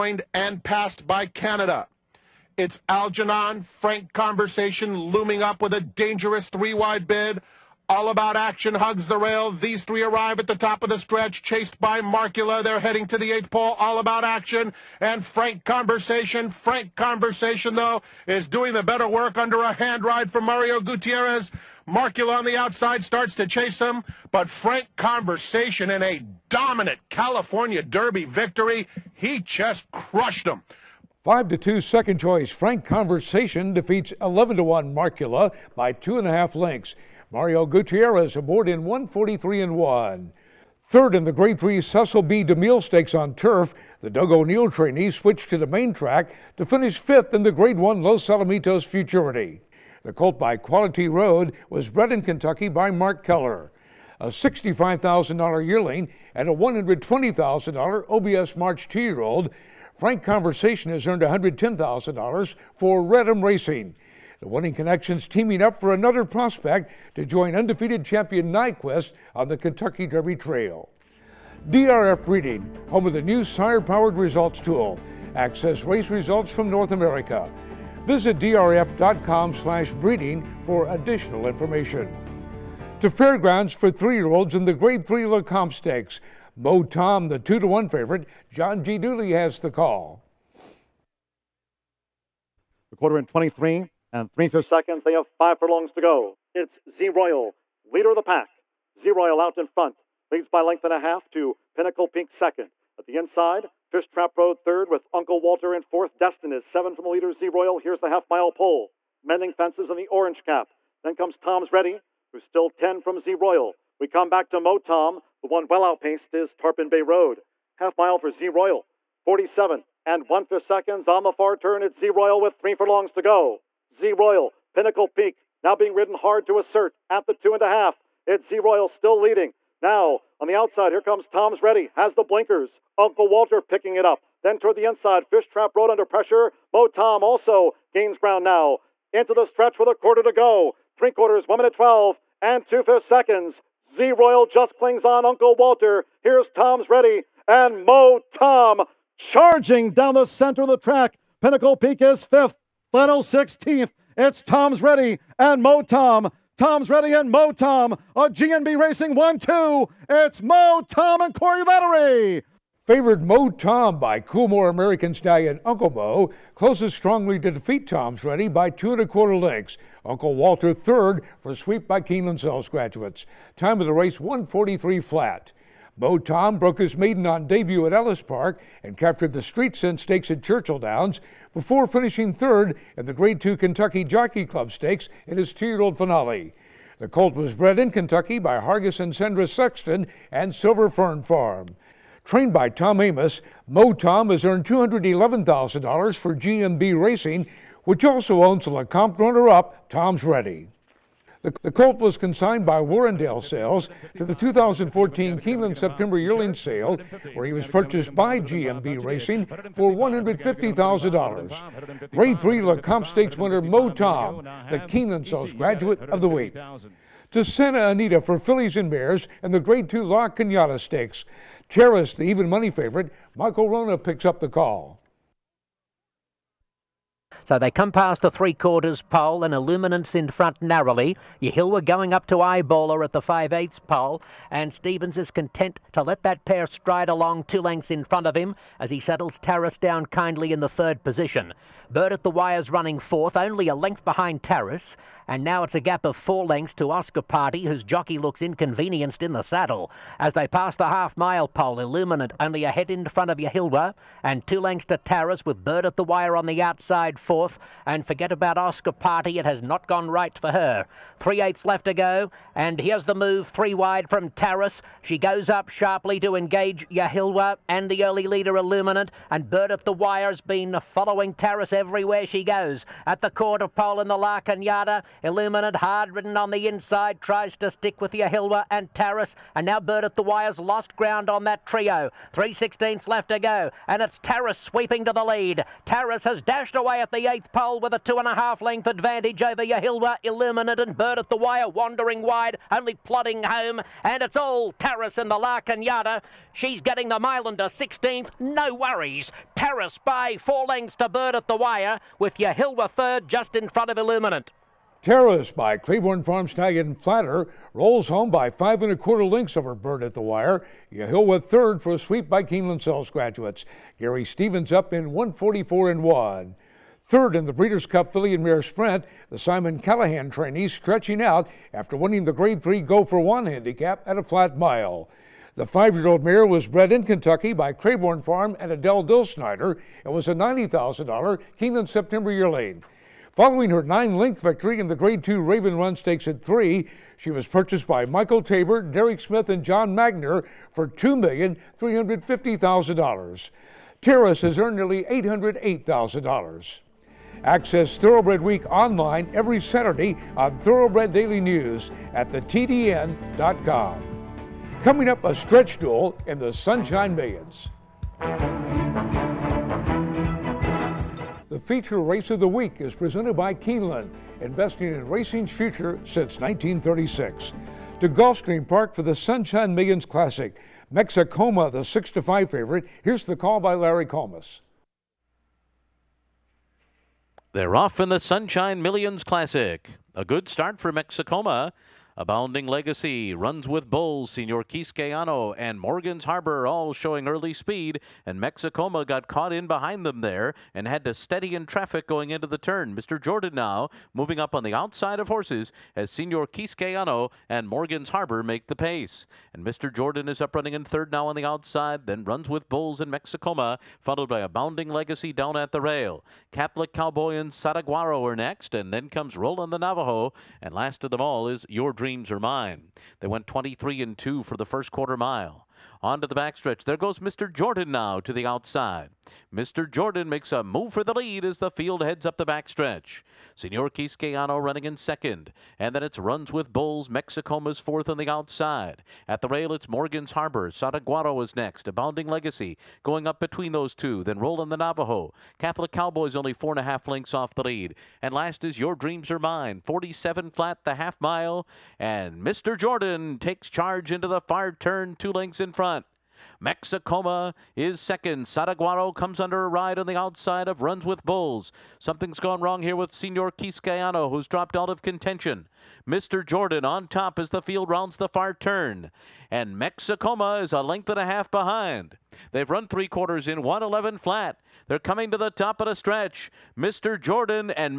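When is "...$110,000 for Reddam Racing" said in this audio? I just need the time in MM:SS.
01:01.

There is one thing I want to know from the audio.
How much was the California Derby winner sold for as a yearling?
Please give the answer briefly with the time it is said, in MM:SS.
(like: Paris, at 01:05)
$65,000, at 00:54.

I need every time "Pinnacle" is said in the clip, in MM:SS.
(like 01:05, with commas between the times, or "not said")
01:41, 02:04, 02:31.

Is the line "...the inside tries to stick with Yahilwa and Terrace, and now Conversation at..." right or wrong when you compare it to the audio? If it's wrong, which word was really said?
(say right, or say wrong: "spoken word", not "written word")
wrong: "Bird", not "Conversation".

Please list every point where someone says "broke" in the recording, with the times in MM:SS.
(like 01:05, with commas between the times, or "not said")
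02:56.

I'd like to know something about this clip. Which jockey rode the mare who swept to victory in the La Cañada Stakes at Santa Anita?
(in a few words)
Gary Stevens.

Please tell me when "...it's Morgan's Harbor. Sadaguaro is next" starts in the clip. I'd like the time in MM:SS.
07:09.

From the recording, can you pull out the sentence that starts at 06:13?
Here's the call by Larry Collmus.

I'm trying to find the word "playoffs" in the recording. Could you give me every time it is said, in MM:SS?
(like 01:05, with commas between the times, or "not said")
not said.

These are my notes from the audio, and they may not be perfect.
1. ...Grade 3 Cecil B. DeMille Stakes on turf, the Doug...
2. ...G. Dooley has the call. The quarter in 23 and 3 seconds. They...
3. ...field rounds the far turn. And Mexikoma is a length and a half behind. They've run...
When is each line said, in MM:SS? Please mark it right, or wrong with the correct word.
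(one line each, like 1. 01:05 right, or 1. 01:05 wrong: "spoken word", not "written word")
1. 00:41 right
2. 01:28 right
3. 07:37 right.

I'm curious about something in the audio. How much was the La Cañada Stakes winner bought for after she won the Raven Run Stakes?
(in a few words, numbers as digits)
$2,350,000.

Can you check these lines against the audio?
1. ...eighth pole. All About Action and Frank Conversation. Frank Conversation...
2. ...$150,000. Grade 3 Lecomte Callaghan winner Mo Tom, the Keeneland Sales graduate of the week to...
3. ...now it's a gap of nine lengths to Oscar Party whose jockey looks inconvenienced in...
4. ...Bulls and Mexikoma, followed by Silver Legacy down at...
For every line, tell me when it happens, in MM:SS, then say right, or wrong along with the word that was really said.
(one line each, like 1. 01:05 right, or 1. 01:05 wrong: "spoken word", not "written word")
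1. 00:13 right
2. 03:29 wrong: "Stakes", not "Callaghan"
3. 04:05 wrong: "four", not "nine"
4. 06:42 wrong: "Abounding", not "Silver".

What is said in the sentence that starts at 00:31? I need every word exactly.
5 to 2 second choice Frank Conversation defeats 11 to 1 Markula by 2.5 lengths.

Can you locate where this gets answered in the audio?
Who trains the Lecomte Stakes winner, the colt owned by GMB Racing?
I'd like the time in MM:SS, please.
03:12.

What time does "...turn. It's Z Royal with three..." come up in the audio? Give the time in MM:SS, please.
02:01.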